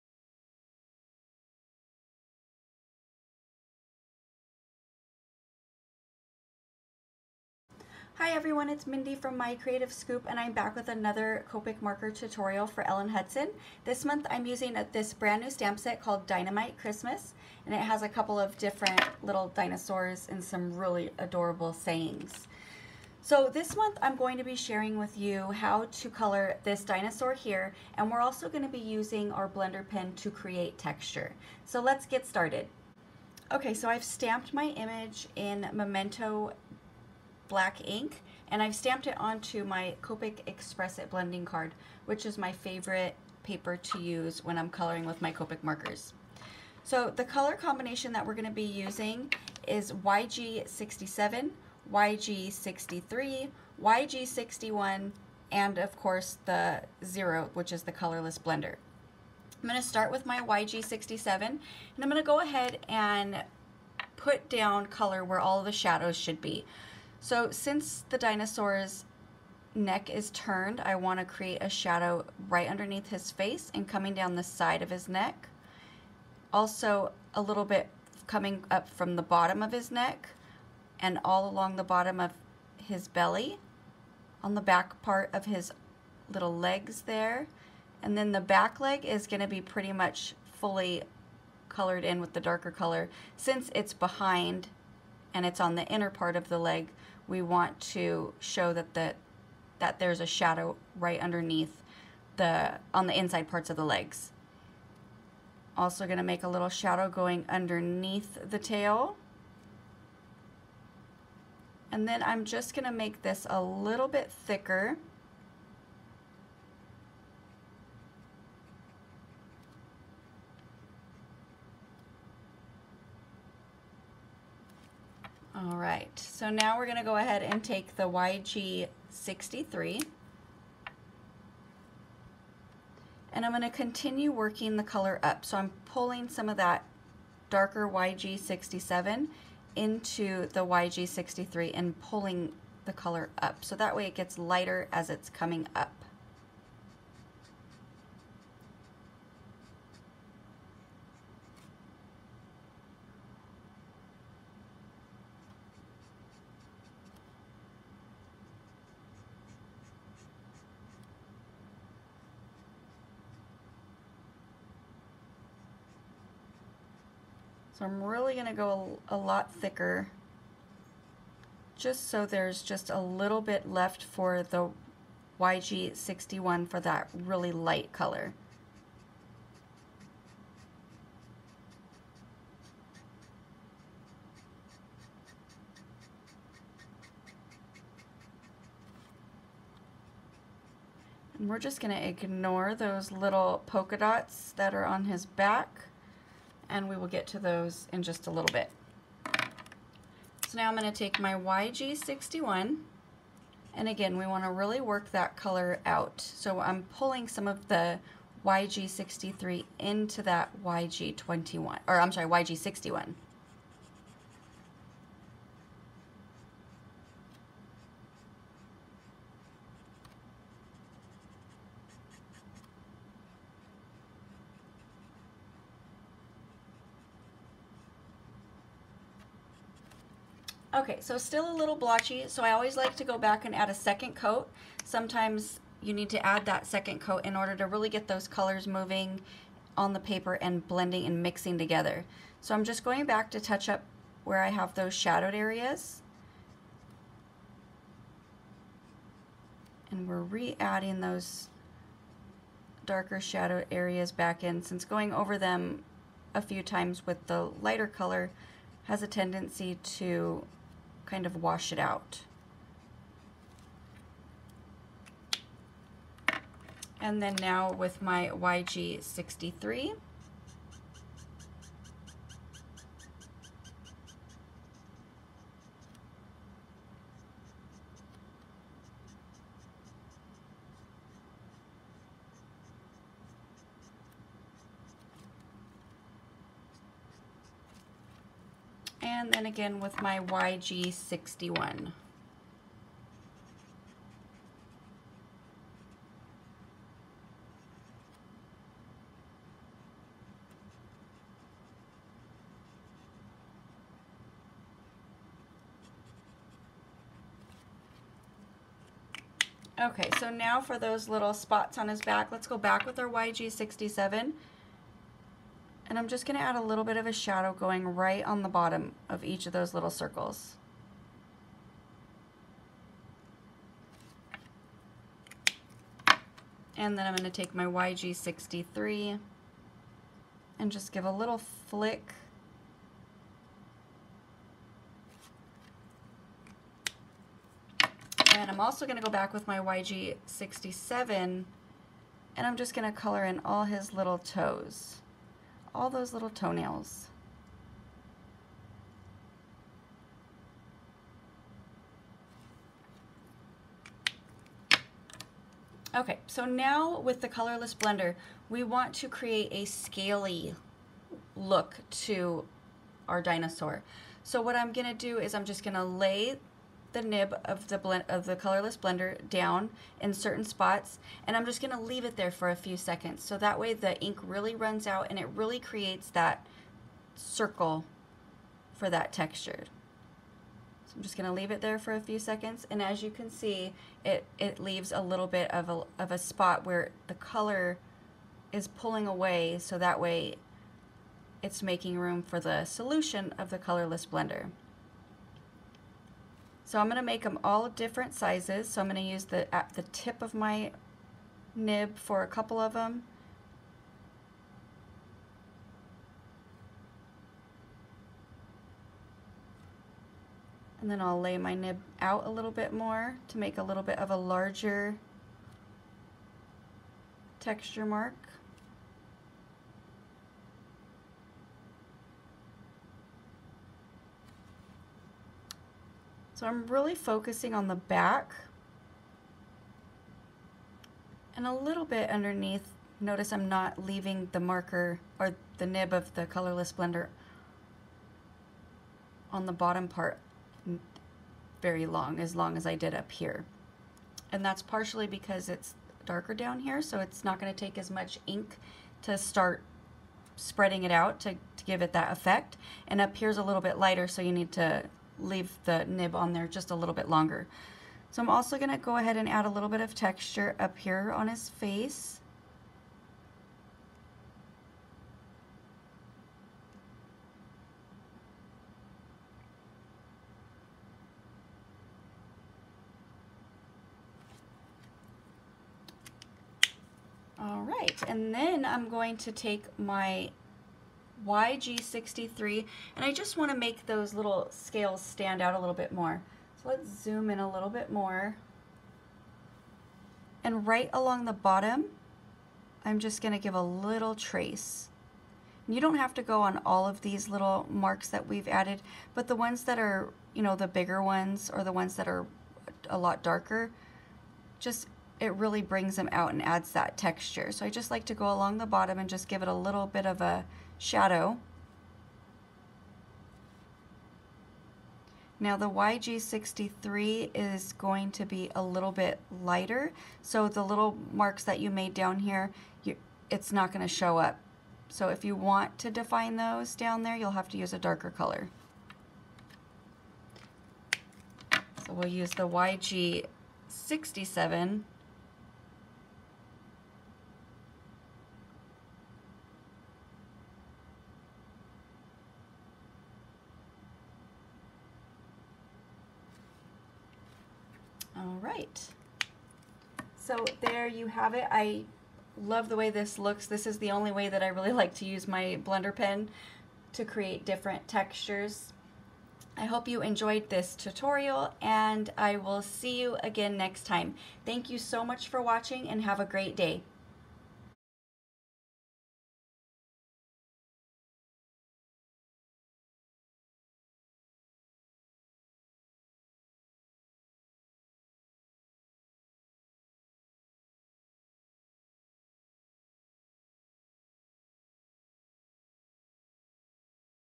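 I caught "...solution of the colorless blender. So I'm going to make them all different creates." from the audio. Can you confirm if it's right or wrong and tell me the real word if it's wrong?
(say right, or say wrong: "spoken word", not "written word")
wrong: "sizes", not "creates".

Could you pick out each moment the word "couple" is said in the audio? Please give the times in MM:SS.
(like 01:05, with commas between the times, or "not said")
00:18, 06:42.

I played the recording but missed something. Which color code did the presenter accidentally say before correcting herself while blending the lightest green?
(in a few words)
YG21.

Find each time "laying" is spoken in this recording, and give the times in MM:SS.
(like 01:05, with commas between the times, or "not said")
not said.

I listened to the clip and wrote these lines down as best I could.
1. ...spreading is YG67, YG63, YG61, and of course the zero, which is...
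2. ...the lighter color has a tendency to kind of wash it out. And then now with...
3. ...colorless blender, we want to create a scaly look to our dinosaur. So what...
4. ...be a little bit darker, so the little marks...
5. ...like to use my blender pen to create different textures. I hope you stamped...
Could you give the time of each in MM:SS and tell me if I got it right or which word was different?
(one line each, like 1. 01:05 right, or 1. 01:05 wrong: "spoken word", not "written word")
1. 00:48 wrong: "using", not "spreading"
2. 04:17 right
3. 05:57 right
4. 08:38 wrong: "lighter", not "darker"
5. 09:14 wrong: "enjoyed", not "stamped".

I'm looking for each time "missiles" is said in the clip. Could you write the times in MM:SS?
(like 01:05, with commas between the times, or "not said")
not said.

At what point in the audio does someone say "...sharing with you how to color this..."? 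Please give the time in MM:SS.
00:24.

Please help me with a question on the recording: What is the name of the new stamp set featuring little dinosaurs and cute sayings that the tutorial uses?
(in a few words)
Dinomite Christmas.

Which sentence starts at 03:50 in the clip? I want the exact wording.
Okay, so still a little blotchy, so I always like to go back and add a second coat.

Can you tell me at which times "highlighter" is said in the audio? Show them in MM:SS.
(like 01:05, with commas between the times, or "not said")
not said.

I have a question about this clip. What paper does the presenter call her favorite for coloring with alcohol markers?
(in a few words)
Copic Express It blending card.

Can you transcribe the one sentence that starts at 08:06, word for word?
So let's zoom in a little bit more and right along the bottom I'm just going to give a little trace.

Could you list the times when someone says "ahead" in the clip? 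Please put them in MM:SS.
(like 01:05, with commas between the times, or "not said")
01:02, 02:07, 07:38.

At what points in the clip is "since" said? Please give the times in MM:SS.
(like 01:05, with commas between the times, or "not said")
01:07, 01:33, 04:14.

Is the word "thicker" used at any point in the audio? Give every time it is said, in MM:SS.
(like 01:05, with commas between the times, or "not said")
01:54, 02:49.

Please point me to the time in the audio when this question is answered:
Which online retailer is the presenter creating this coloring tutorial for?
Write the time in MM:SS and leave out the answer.
00:12.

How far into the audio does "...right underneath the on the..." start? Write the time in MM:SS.
01:40.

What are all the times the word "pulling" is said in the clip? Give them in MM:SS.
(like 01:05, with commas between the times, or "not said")
02:15, 02:22, 03:26, 06:28.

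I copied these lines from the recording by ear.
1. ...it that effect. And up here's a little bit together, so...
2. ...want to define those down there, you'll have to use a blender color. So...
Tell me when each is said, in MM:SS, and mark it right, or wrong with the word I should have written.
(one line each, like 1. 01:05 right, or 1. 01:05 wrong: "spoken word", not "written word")
1. 07:31 wrong: "lighter", not "together"
2. 08:45 wrong: "darker", not "blender".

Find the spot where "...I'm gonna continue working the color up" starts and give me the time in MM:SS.
02:13.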